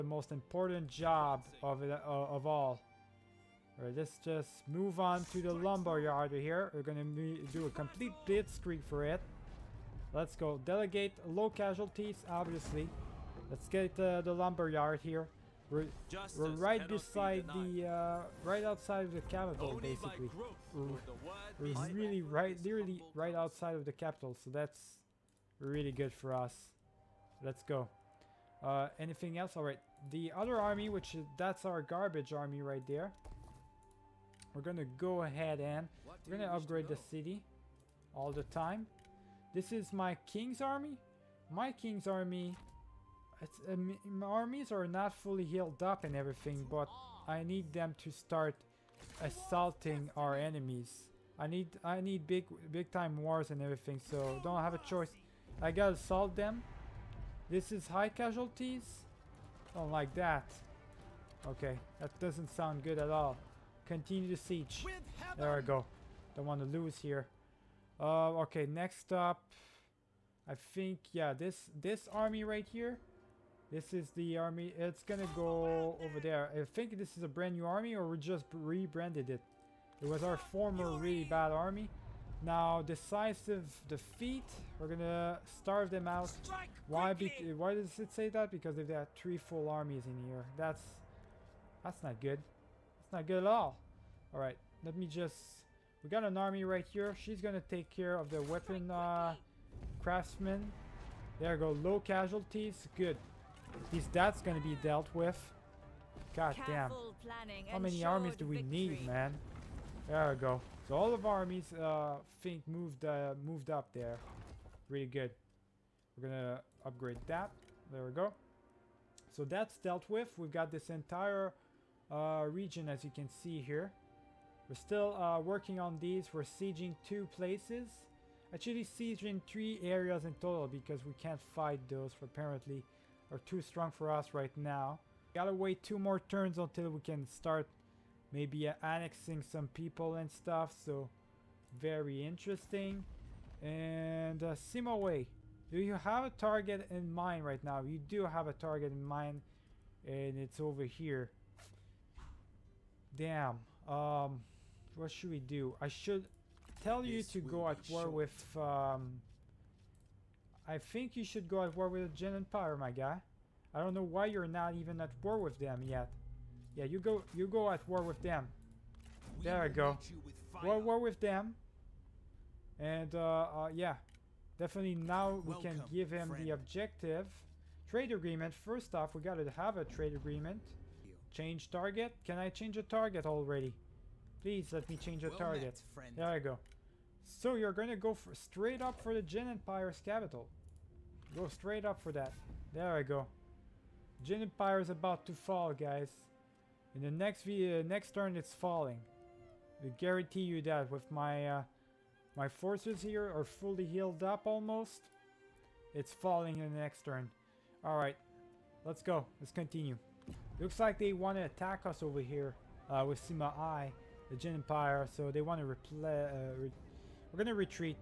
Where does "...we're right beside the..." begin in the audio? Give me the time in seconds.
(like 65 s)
16 s.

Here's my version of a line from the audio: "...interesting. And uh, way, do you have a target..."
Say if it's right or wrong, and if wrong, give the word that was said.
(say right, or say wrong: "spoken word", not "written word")
right.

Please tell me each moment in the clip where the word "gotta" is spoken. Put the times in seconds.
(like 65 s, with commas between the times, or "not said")
55 s, 135 s, 179 s.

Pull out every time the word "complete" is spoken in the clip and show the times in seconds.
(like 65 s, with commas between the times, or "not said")
7 s.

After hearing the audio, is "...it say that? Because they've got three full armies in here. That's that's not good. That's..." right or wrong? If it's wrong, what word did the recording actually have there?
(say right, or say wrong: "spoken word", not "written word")
right.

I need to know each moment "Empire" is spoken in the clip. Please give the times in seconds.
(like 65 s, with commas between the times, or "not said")
162 s, 189 s, 194 s, 214 s.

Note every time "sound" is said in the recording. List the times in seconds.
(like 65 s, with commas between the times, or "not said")
62 s.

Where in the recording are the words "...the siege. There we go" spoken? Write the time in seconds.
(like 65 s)
64 s.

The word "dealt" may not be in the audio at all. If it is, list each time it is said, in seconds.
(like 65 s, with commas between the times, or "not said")
104 s, 119 s.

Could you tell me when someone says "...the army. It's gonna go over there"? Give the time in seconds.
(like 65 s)
74 s.